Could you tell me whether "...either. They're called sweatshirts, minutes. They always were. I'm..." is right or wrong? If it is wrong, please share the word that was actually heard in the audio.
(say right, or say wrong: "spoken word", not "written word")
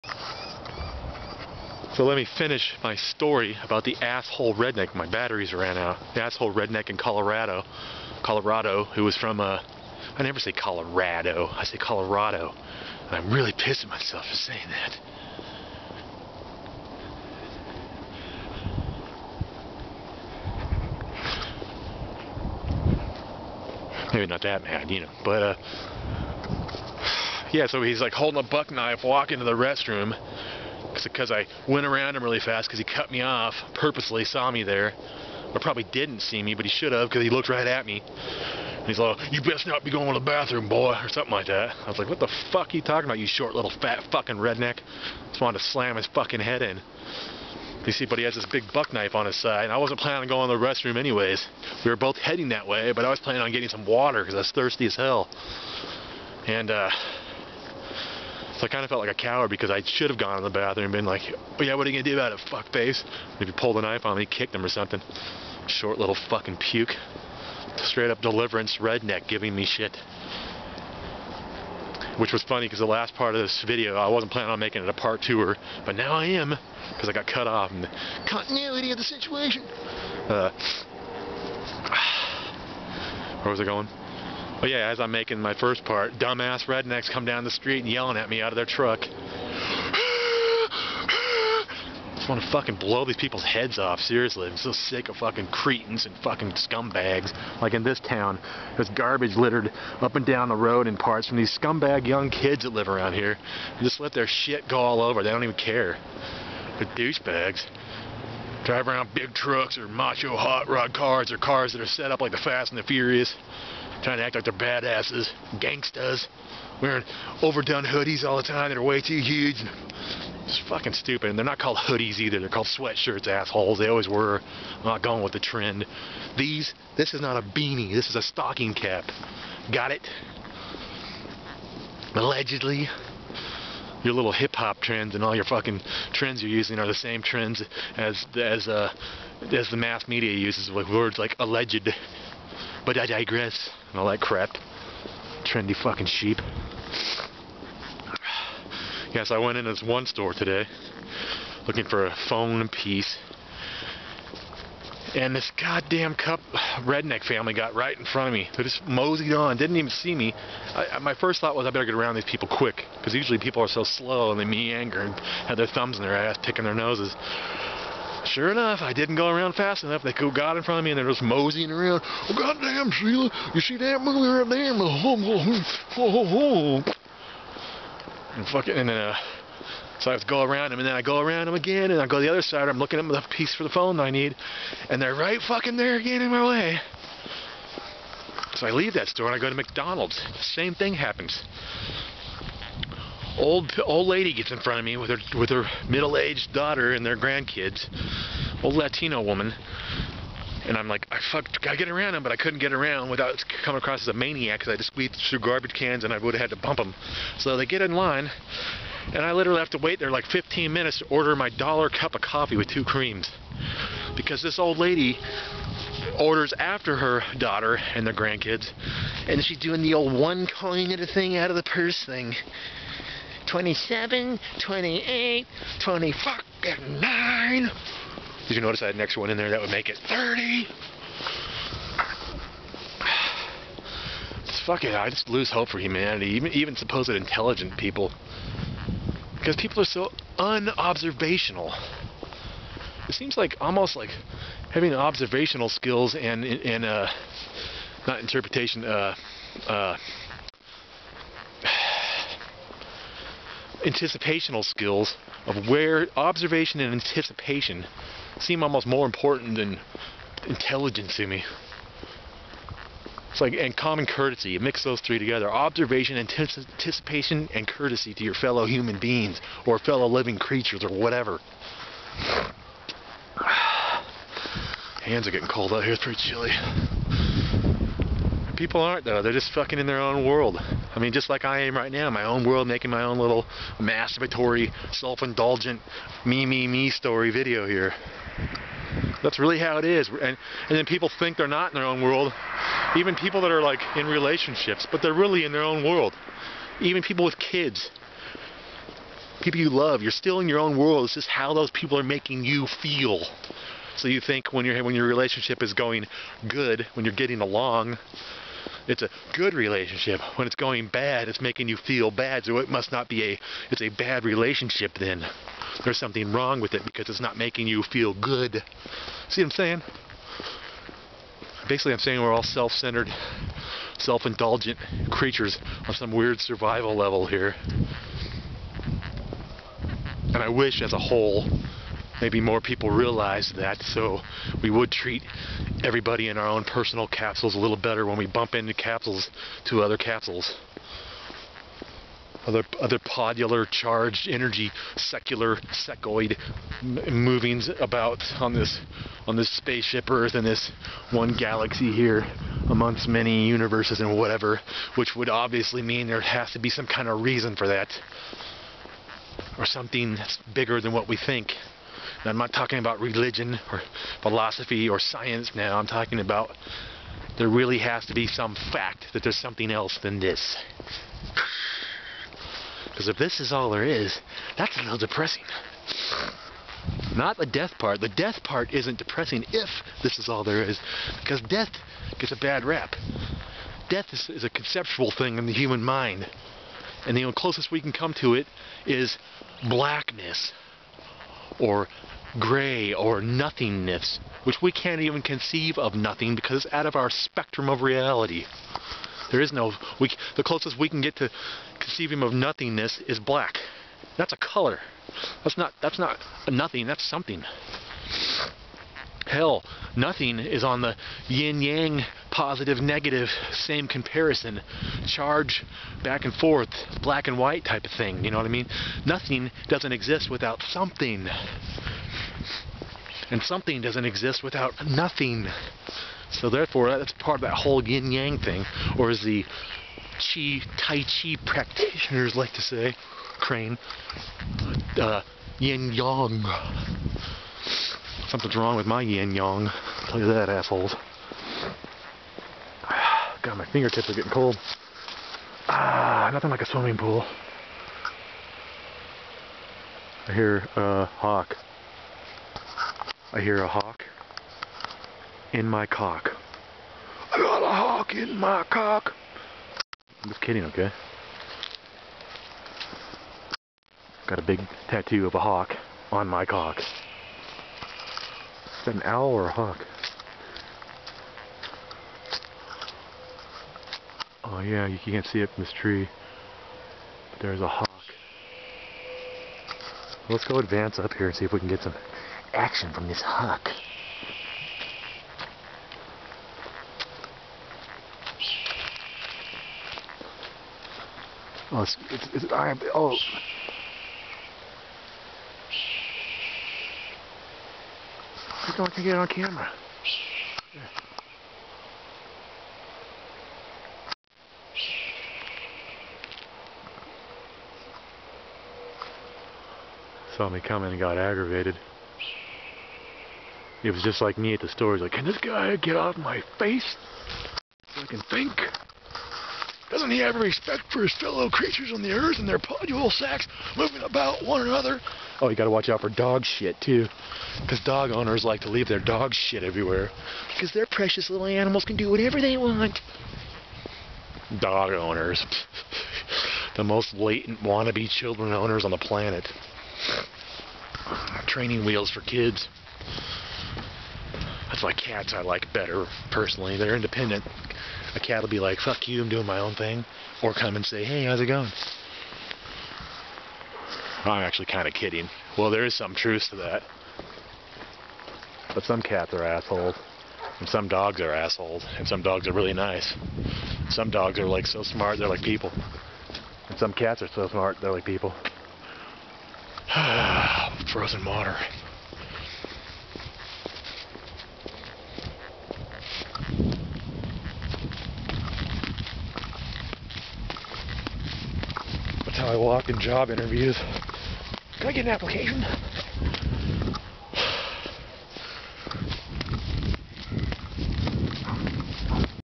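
wrong: "assholes", not "minutes".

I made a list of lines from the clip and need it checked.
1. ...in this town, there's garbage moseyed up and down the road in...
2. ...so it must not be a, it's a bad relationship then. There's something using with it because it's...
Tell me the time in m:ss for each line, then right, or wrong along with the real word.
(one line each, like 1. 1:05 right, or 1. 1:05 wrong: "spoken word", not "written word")
1. 1:37 wrong: "littered", not "moseyed"
2. 5:12 wrong: "wrong", not "using".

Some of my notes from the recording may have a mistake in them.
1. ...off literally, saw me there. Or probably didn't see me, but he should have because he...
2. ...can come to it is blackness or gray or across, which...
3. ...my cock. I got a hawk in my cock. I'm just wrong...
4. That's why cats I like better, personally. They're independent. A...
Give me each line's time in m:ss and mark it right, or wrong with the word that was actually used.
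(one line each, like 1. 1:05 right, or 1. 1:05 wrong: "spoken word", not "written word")
1. 0:33 wrong: "purposely", not "literally"
2. 6:27 wrong: "nothingness", not "across"
3. 7:35 wrong: "kidding", not "wrong"
4. 9:04 right.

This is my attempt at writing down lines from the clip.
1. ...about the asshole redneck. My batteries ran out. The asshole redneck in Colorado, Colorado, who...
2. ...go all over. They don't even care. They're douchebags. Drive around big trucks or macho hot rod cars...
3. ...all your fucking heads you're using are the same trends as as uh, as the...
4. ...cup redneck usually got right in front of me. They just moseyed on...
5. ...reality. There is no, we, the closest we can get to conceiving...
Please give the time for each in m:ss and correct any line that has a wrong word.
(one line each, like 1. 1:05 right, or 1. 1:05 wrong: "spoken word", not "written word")
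1. 0:03 right
2. 1:44 right
3. 2:15 wrong: "trends", not "heads"
4. 2:36 wrong: "family", not "usually"
5. 6:37 right.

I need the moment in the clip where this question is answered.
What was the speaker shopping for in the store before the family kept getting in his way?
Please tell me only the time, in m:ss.
2:32.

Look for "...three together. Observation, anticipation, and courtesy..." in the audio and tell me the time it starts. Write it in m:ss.
4:24.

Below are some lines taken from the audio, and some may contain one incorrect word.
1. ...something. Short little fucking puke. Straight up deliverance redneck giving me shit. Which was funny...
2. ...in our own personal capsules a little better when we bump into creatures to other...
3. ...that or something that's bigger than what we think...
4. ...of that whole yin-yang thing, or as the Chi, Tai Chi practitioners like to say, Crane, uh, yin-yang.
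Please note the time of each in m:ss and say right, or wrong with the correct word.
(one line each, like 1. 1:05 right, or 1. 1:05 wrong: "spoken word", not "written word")
1. 1:04 right
2. 5:36 wrong: "capsules", not "creatures"
3. 5:57 right
4. 7:07 right.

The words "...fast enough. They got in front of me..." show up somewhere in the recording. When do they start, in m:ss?
2:49.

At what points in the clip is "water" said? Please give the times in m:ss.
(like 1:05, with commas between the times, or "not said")
0:53, 9:31.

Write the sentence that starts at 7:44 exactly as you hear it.
Got a big tattoo of a hawk on my cock.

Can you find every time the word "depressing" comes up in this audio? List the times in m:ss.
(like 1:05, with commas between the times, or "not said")
6:14, 6:18.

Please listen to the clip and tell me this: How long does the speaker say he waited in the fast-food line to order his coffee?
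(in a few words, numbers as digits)
15 minutes.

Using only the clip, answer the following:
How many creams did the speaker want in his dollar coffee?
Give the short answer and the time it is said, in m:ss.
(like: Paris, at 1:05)
2, at 3:32.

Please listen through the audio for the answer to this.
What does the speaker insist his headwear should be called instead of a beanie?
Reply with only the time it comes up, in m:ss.
2:08.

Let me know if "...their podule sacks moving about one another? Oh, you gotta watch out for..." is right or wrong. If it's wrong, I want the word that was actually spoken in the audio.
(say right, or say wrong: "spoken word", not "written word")
right.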